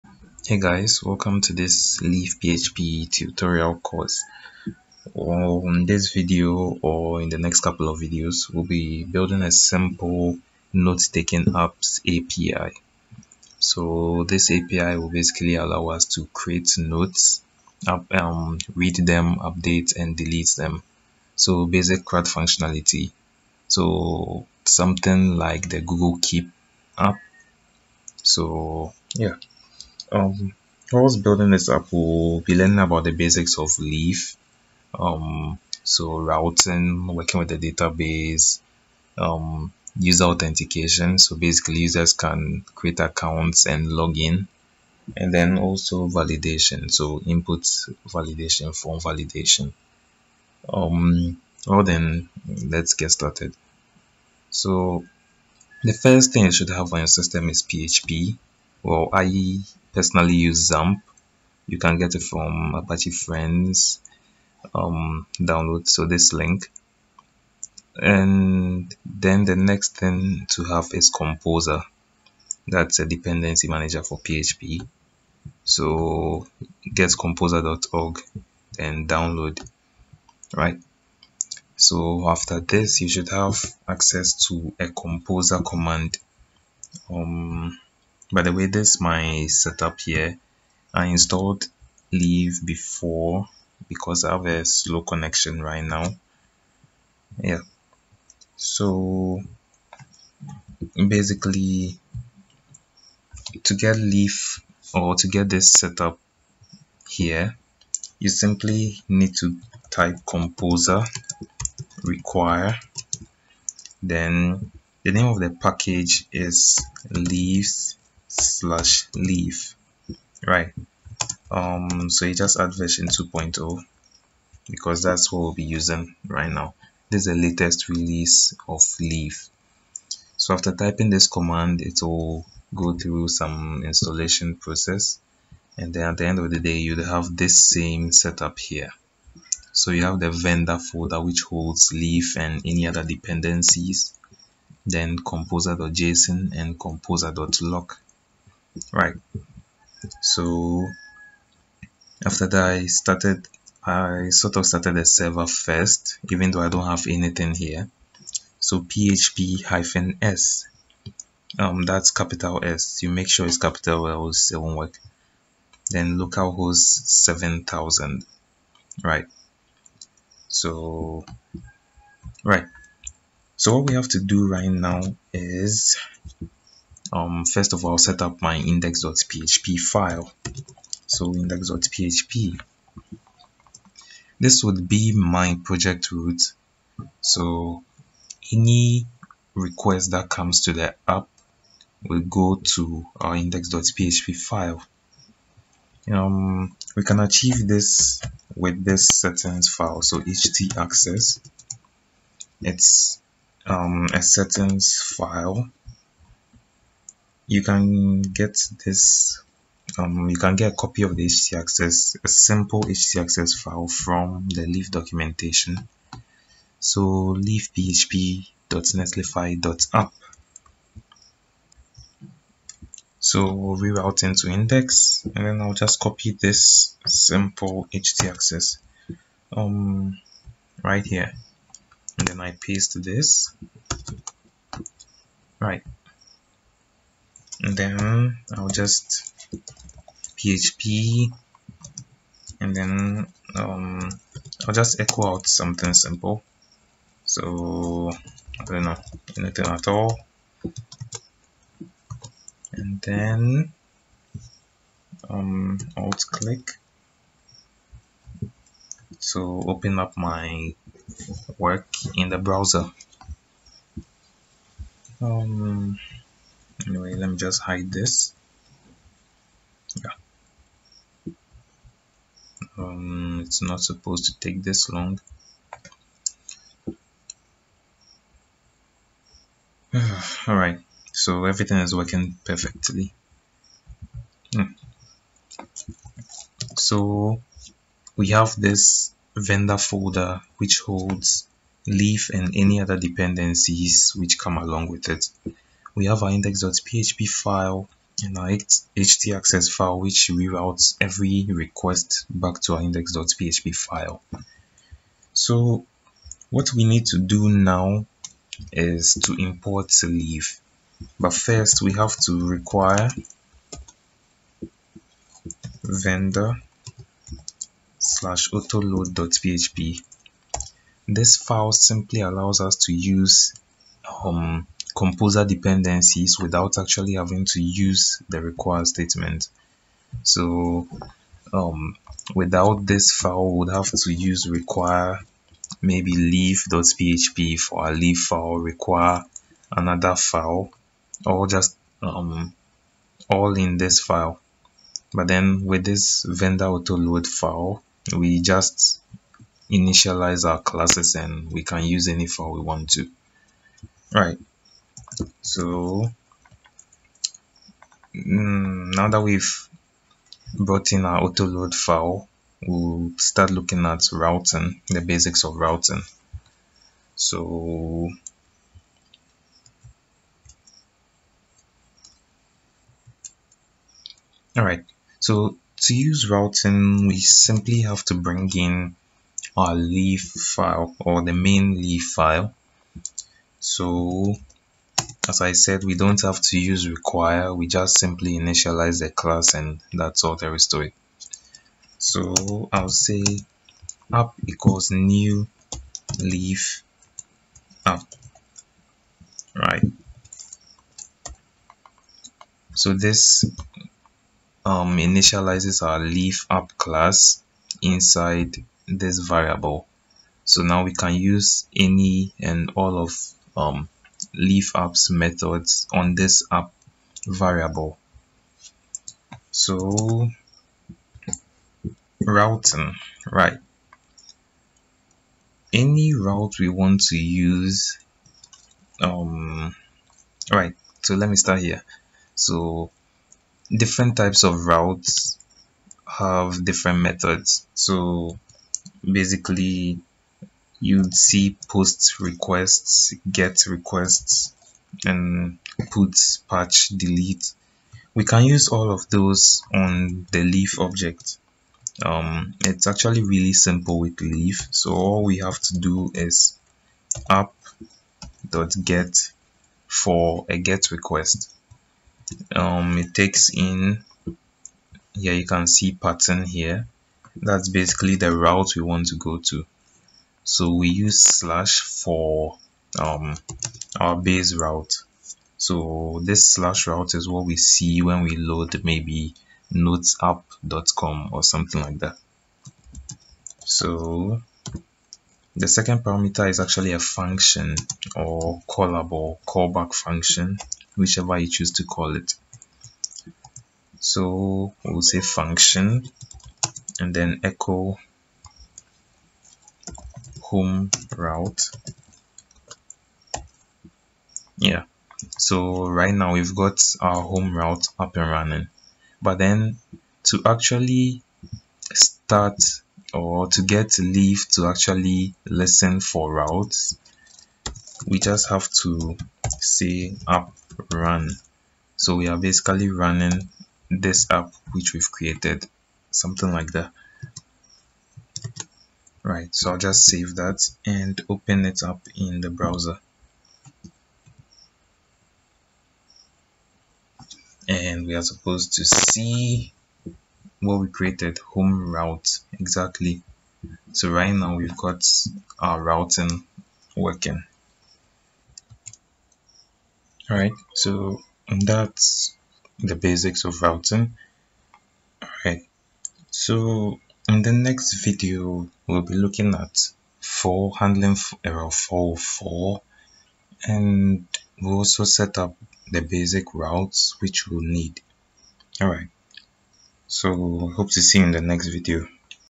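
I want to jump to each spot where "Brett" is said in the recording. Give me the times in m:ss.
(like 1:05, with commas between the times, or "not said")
not said.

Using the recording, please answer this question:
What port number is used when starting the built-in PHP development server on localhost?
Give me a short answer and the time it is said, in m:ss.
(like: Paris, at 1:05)
7000, at 2:47.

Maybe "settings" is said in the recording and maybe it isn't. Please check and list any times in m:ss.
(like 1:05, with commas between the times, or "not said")
3:19, 3:24.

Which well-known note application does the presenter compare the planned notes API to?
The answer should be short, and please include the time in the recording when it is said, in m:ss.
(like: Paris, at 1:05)
Google Keep, at 0:25.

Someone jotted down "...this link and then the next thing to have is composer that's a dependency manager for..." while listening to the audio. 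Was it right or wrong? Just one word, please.
right.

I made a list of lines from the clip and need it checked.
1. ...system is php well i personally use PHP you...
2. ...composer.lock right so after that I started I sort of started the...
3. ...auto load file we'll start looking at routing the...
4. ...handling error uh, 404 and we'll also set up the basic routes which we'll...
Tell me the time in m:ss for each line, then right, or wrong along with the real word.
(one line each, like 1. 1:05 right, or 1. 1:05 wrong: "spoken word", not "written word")
1. 0:57 wrong: "XAMPP", not "PHP"
2. 2:26 right
3. 6:01 right
4. 9:20 right.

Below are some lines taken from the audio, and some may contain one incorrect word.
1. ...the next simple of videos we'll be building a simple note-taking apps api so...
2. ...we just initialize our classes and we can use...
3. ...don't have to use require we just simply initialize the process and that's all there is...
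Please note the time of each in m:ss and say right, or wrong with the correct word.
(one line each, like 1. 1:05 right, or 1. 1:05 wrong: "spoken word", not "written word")
1. 0:07 wrong: "couple", not "simple"
2. 5:48 right
3. 6:25 wrong: "class", not "process".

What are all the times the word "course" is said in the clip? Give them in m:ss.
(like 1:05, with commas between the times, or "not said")
0:03.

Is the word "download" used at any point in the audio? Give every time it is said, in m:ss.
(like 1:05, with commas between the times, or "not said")
1:05, 1:19.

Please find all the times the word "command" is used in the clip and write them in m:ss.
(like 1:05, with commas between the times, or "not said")
1:25, 2:11.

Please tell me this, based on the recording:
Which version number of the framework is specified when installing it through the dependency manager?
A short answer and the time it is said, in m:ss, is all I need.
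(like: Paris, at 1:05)
2.0, at 2:03.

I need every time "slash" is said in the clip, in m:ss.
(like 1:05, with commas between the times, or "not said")
1:58, 5:17, 7:51, 7:56.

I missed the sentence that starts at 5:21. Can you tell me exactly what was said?
This file simply allows us to use um, composer dependencies without actually having to use the require statement.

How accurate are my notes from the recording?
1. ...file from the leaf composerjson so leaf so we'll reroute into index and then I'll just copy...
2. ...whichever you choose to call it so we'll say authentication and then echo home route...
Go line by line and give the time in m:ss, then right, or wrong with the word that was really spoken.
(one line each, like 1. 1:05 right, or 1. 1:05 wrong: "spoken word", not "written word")
1. 3:33 wrong: "documentation", not "composerjson"
2. 8:10 wrong: "function", not "authentication".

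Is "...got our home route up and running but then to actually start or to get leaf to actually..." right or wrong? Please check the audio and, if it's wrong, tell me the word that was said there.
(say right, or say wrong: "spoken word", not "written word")
right.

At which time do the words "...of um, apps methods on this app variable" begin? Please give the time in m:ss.
6:52.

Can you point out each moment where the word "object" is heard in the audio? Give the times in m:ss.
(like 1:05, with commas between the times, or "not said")
7:30.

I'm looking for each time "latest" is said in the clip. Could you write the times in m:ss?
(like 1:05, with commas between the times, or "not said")
2:07.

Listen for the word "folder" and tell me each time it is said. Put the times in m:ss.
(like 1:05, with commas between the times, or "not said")
2:20, 4:49.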